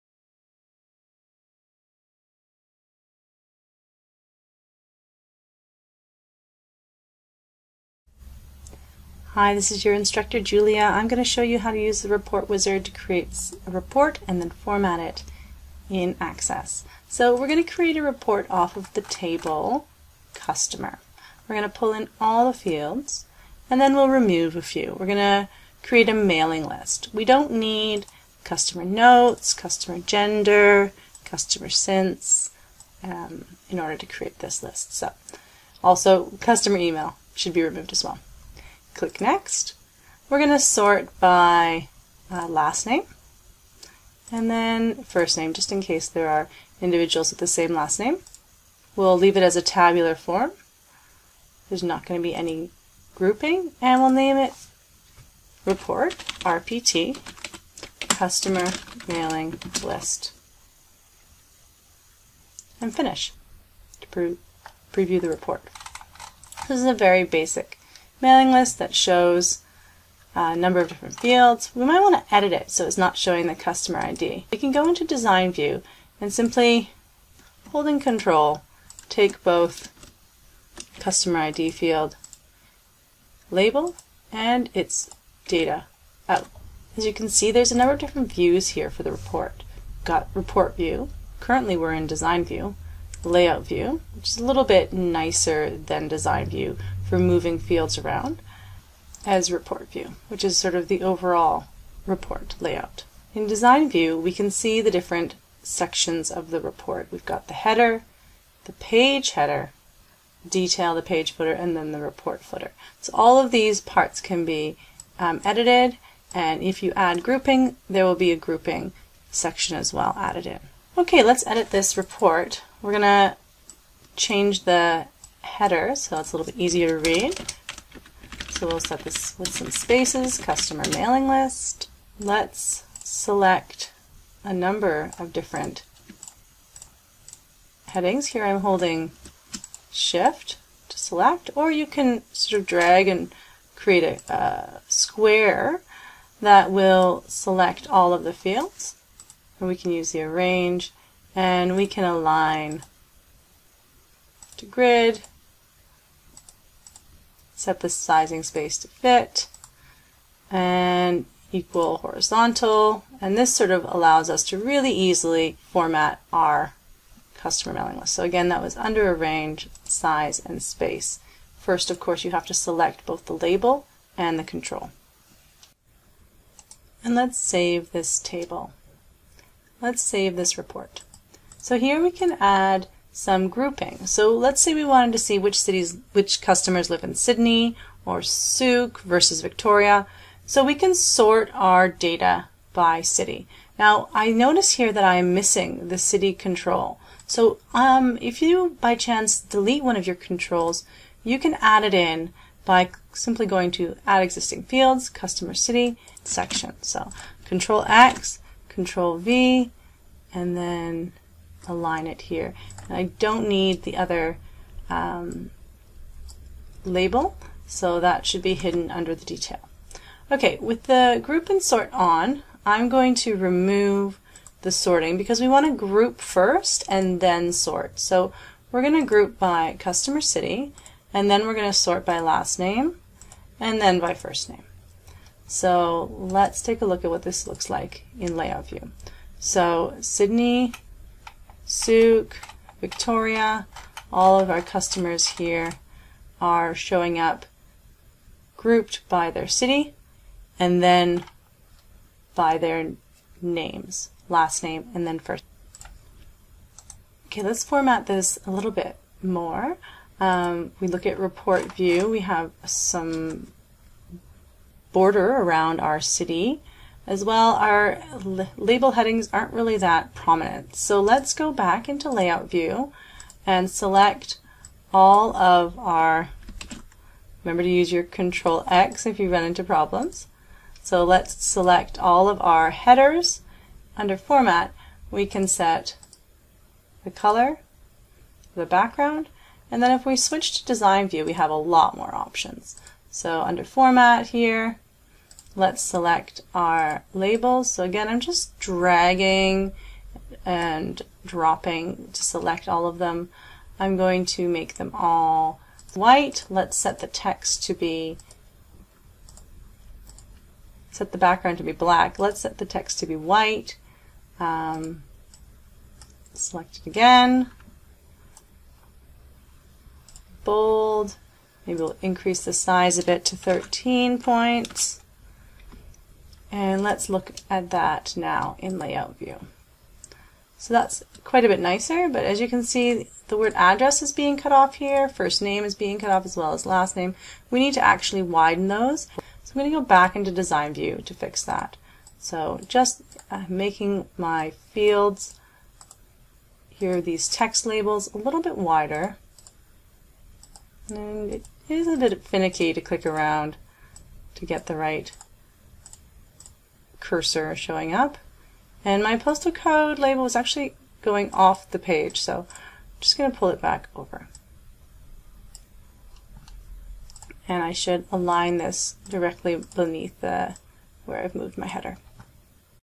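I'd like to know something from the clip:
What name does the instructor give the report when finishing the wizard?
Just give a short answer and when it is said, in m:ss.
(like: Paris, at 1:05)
RPT Customer Mailing List, at 0:56.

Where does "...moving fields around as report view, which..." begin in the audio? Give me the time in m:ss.
1:37.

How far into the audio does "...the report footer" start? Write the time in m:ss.
1:51.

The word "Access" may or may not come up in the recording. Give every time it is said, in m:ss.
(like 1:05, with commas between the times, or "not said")
0:16.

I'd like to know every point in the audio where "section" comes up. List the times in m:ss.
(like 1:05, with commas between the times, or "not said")
1:45, 1:59, 3:26.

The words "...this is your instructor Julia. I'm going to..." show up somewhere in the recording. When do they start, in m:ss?
0:09.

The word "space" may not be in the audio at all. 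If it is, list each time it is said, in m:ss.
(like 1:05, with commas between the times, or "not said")
2:09, 2:38, 2:50.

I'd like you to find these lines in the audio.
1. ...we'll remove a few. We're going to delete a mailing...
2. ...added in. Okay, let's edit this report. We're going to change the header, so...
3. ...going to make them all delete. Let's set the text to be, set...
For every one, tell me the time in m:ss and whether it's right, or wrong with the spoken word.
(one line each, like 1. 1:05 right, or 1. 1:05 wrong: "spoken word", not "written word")
1. 0:23 wrong: "create", not "delete"
2. 2:00 right
3. 5:03 wrong: "white", not "delete".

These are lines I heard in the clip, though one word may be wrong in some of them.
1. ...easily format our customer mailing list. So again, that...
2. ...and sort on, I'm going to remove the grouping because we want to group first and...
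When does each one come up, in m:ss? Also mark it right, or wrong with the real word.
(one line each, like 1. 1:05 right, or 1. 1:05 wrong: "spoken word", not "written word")
1. 2:44 right
2. 3:41 wrong: "sorting", not "grouping".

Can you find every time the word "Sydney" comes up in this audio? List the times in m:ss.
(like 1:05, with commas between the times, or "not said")
3:07, 3:59.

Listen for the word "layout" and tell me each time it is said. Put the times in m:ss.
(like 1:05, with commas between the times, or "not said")
1:33, 1:42, 3:58, 4:32, 5:28.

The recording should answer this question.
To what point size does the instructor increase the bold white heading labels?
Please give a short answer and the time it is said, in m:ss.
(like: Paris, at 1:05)
13, at 5:23.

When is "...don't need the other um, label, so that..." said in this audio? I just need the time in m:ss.
3:33.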